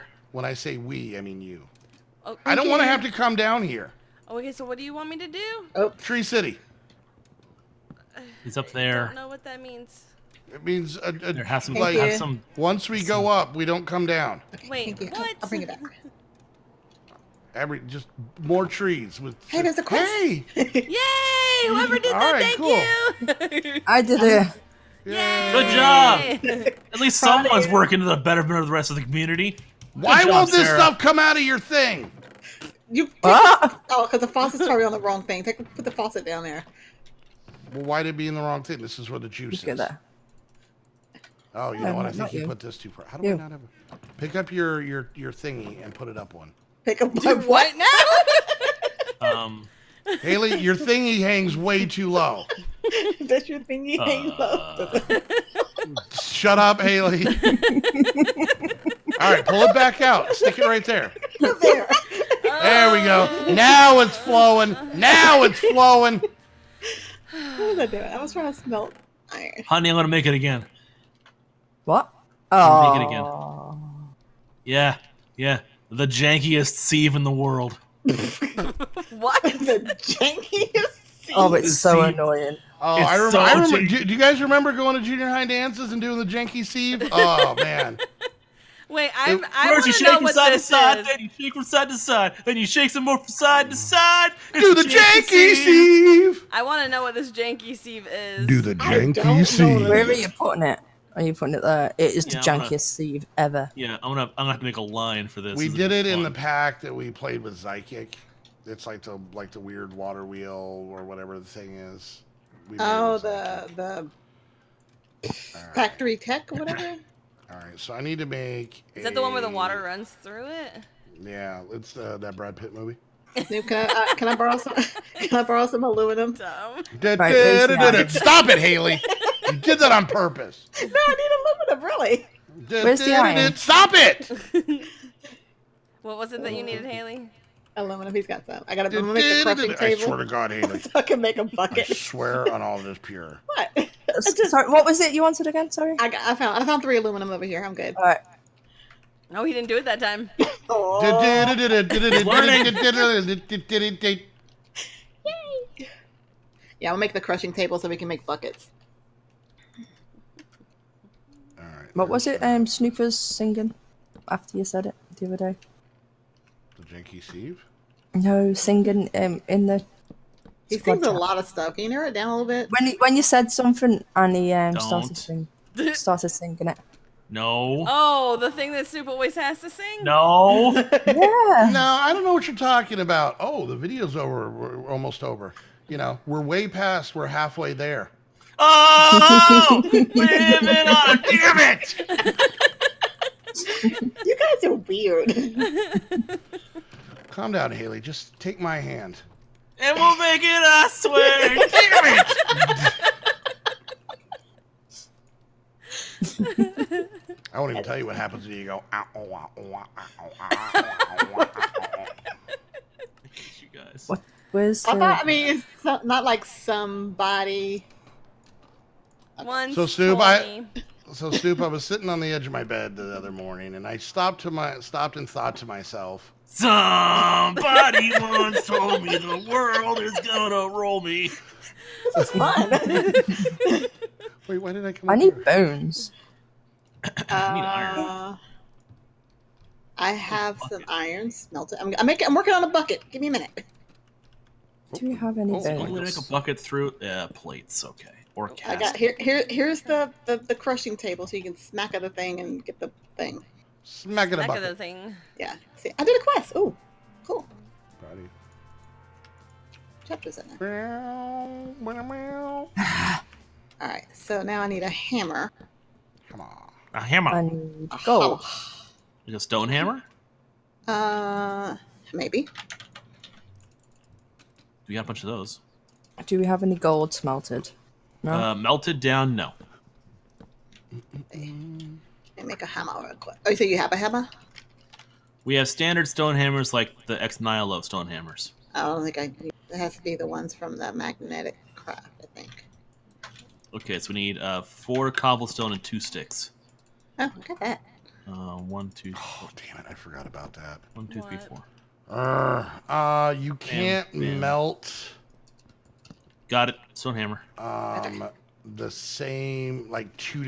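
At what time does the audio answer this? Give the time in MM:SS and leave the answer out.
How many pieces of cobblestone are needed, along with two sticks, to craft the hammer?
04:54.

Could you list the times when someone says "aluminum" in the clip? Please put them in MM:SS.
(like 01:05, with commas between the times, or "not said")
02:05, 02:11, 02:17, 02:26.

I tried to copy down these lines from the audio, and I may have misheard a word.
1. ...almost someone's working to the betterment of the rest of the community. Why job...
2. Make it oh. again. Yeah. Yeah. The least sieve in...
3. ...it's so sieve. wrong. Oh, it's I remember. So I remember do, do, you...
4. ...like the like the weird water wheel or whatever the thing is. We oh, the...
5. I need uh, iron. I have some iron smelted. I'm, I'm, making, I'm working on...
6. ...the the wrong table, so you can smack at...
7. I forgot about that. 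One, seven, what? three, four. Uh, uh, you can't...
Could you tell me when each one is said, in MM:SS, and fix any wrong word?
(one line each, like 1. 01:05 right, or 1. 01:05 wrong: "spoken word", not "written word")
1. 00:26 wrong: "least", not "almost"
2. 01:12 wrong: "jankiest", not "least"
3. 01:21 wrong: "annoying", not "wrong"
4. 01:48 right
5. 03:57 right
6. 04:10 wrong: "crushing", not "wrong"
7. 04:59 wrong: "two", not "seven".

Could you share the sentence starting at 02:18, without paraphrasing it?
I gotta make a crushing table.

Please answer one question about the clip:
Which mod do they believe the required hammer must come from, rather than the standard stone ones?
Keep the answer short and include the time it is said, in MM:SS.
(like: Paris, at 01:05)
Magnetic craft, at 04:50.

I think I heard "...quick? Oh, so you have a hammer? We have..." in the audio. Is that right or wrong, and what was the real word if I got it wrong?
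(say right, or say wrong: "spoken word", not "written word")
right.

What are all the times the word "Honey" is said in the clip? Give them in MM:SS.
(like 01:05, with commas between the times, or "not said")
01:09.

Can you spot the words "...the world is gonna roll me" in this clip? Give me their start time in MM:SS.
03:49.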